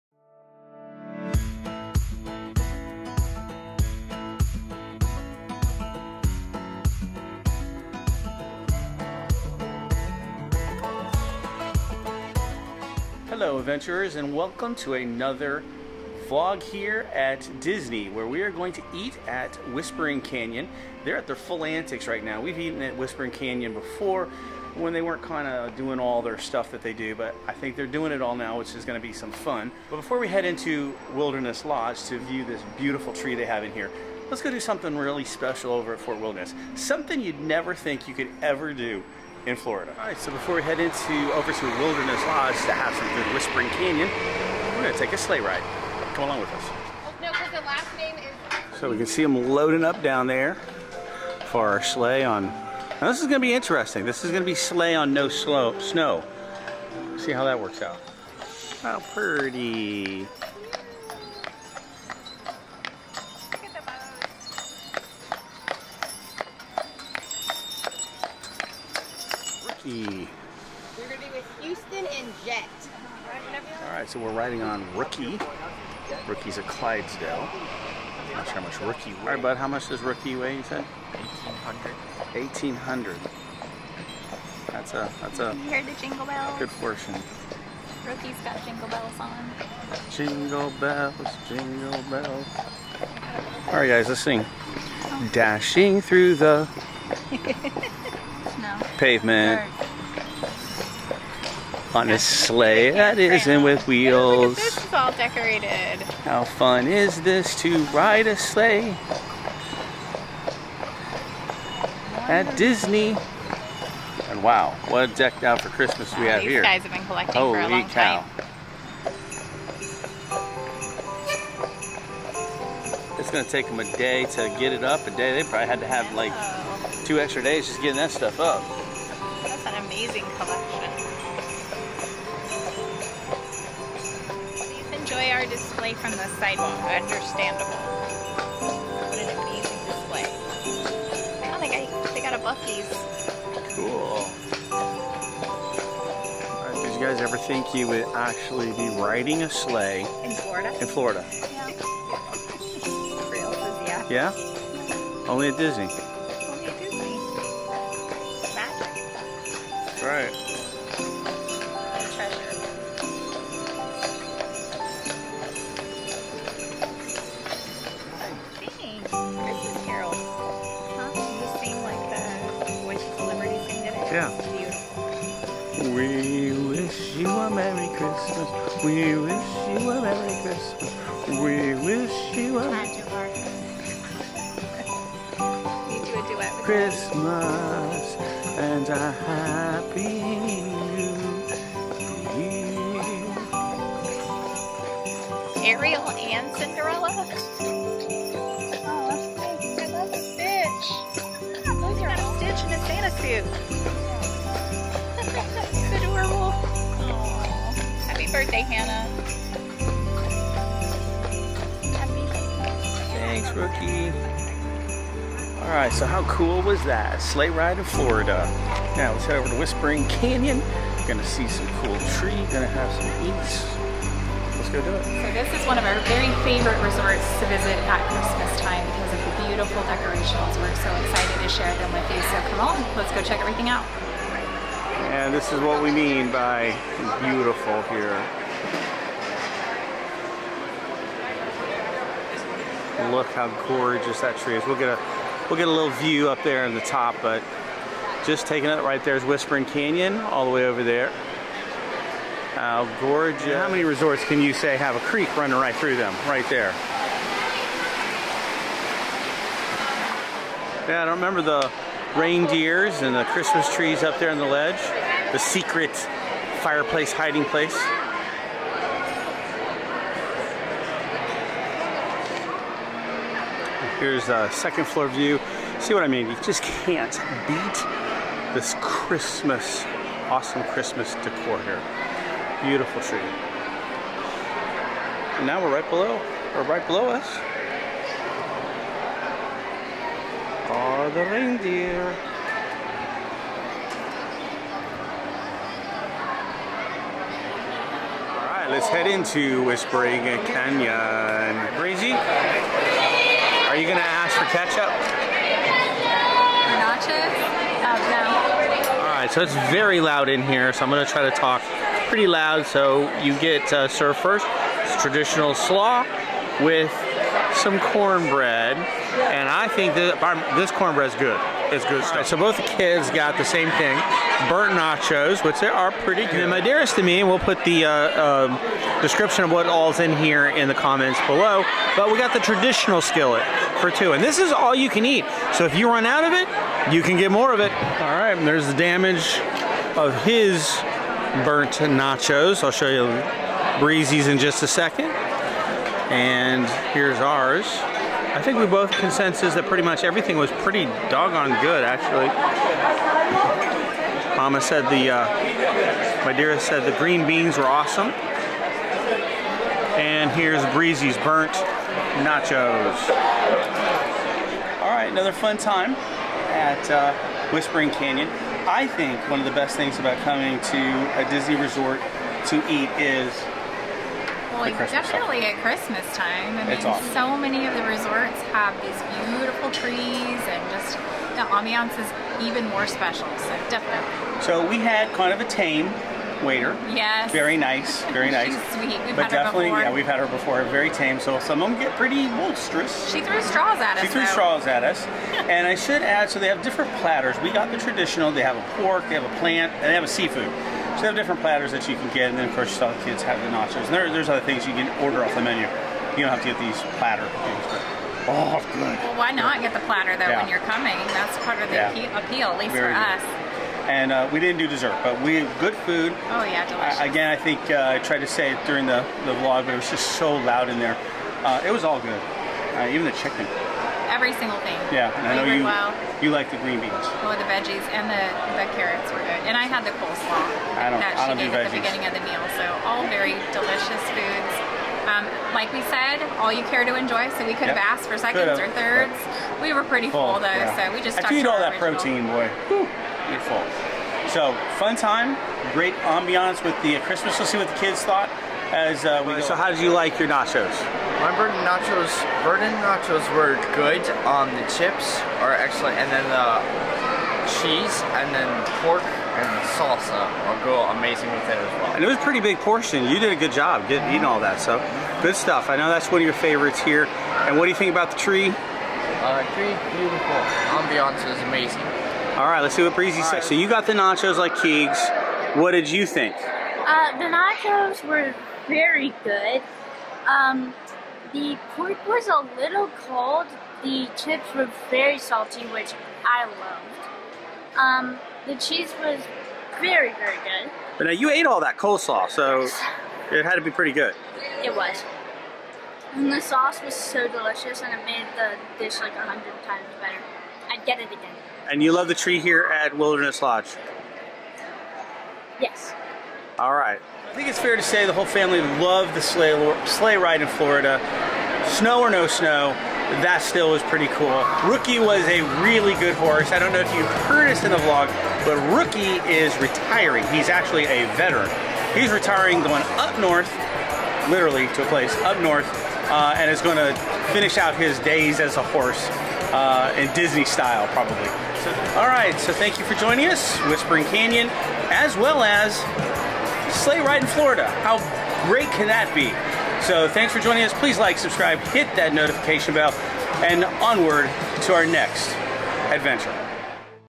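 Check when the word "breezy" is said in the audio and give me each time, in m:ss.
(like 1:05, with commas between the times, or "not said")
5:01, 5:43, 6:00, 7:52.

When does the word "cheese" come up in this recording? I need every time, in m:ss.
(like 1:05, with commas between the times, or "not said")
7:37, 8:08.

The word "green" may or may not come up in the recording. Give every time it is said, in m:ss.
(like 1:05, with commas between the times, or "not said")
5:56, 7:06.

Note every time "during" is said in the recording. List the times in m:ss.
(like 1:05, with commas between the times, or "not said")
6:58.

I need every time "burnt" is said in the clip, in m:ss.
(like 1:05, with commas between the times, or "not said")
5:24, 5:41, 6:01.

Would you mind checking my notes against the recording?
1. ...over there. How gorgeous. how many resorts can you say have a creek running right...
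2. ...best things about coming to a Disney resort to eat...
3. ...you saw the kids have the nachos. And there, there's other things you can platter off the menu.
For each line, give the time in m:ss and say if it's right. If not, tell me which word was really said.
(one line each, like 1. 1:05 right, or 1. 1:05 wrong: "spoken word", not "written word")
1. 4:10 right
2. 6:09 right
3. 6:42 wrong: "order", not "platter".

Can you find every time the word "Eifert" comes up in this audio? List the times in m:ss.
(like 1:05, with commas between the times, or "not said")
not said.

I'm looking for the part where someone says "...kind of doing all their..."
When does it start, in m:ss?
0:25.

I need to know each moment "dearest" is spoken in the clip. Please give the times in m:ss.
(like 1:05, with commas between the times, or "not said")
5:26, 5:56.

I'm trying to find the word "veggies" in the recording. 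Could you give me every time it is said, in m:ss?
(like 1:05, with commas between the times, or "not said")
7:07.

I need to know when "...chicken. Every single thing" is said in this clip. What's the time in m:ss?
7:03.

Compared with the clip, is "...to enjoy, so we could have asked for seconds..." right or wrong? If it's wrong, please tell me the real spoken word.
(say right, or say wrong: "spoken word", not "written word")
right.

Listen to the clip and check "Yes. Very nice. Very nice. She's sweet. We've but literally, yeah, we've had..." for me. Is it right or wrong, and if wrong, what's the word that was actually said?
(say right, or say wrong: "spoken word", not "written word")
wrong: "definitely", not "literally".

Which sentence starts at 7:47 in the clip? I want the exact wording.
And what do you think about the tree?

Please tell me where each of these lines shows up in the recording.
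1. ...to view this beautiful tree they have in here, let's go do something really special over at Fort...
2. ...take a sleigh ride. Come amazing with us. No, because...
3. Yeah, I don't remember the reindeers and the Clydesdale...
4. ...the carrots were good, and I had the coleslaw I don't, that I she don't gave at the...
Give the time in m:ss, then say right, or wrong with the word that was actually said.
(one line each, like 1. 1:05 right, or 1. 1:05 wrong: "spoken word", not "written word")
1. 0:32 right
2. 0:44 wrong: "along", not "amazing"
3. 4:20 wrong: "Christmas", not "Clydesdale"
4. 7:08 right.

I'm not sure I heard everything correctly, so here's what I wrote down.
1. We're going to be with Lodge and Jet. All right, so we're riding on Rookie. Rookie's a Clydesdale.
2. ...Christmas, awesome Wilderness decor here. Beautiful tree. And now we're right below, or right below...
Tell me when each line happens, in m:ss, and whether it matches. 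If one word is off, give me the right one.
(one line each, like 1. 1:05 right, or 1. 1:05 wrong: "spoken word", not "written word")
1. 1:10 wrong: "Houston", not "Lodge"
2. 4:38 wrong: "Christmas", not "Wilderness".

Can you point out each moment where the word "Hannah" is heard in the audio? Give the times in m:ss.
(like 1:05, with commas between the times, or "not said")
3:28.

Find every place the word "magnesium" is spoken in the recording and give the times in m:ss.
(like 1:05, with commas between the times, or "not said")
not said.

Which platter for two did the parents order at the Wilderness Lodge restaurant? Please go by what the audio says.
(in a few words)
traditional skillet.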